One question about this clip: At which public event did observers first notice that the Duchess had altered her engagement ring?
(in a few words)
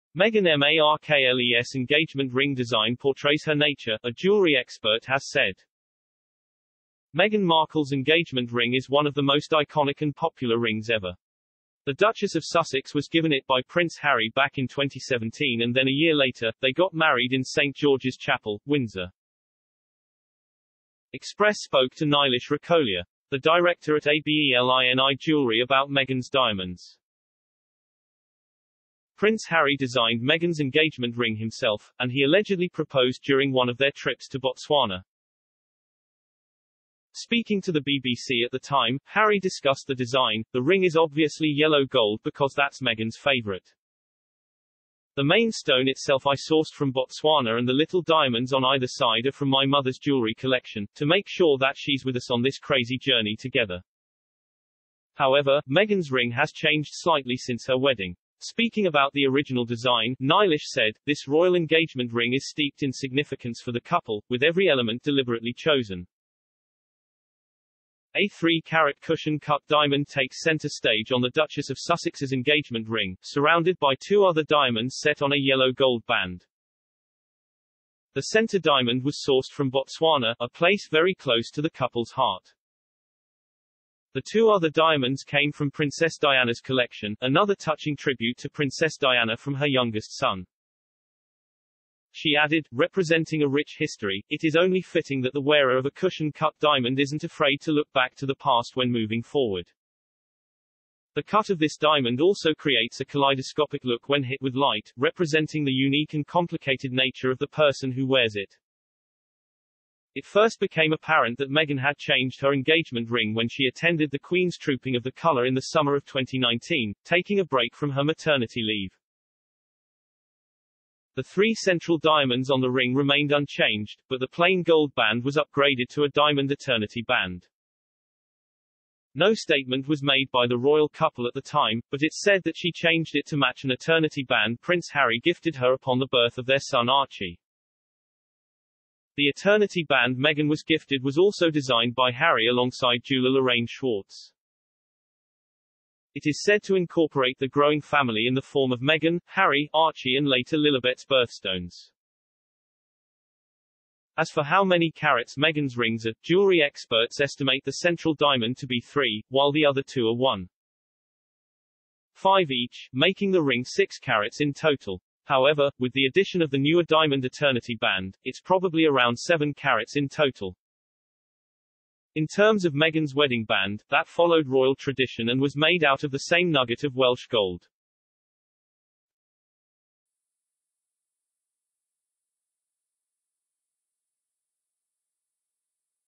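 Trooping of the Colour.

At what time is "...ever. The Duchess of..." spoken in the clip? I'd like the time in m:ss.
0:10.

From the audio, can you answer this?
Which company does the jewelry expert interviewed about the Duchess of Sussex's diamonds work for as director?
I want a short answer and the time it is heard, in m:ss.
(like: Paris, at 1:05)
ABELINI Jewelry, at 0:24.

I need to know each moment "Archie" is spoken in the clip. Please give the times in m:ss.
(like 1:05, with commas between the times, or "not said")
2:16, 2:29.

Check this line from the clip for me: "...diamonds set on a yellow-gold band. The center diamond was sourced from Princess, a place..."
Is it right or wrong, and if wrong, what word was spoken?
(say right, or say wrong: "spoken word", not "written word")
wrong: "Botswana", not "Princess".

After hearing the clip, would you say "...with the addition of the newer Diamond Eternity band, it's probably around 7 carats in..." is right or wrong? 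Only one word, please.
right.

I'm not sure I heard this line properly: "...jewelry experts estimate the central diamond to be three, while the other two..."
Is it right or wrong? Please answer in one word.
right.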